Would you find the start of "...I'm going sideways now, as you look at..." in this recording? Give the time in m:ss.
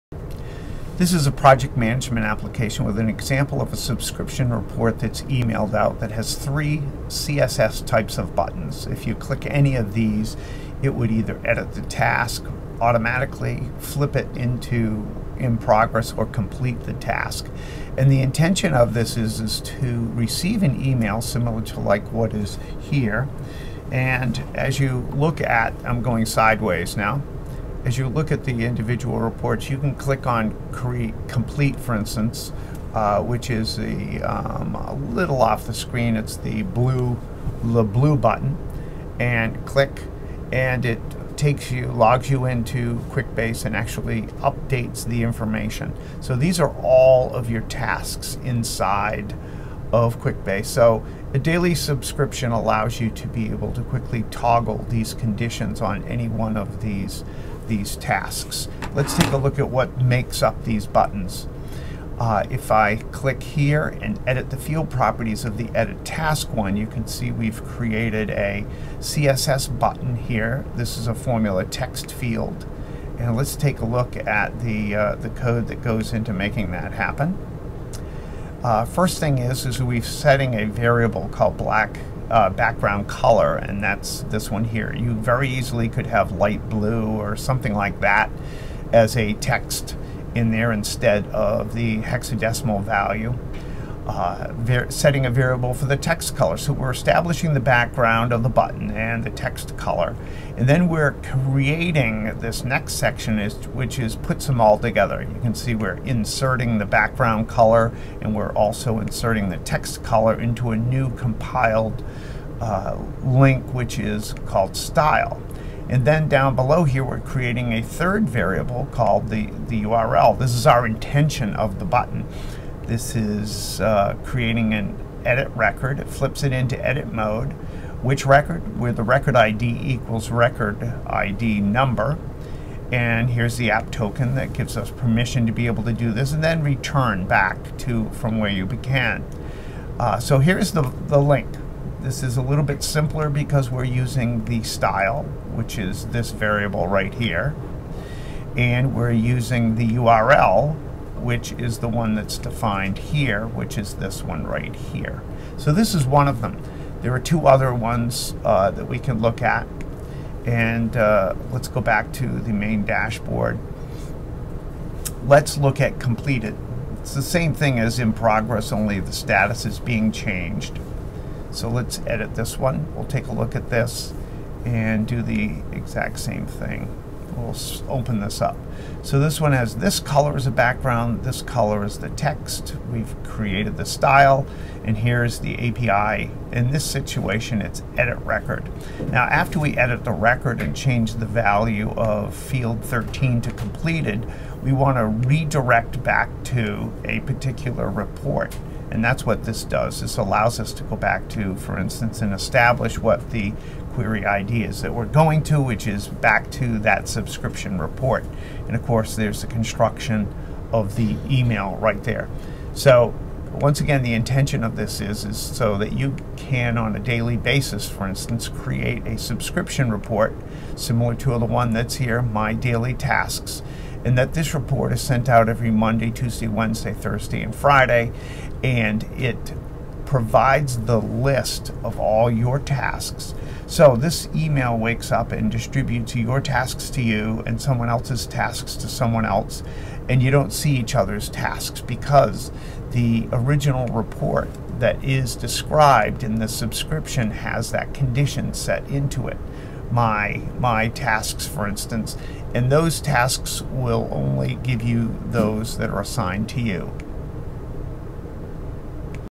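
0:25.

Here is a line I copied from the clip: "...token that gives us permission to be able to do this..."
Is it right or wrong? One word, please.
right.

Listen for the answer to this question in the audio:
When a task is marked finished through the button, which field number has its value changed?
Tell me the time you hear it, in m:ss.
3:12.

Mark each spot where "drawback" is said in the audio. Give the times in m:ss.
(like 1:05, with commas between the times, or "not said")
not said.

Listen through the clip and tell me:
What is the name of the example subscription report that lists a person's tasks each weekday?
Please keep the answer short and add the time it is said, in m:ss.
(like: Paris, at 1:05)
My Daily Tasks, at 3:42.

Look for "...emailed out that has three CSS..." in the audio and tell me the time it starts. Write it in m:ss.
0:05.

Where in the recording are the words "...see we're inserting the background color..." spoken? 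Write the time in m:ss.
1:45.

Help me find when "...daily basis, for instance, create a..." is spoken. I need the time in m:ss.
3:36.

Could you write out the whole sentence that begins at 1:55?
And then down below here, we're creating a third variable called the, the URL.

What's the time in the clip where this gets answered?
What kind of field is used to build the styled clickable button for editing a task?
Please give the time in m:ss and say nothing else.
1:11.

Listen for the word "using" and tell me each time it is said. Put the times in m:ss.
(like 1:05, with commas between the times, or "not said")
2:23, 2:29.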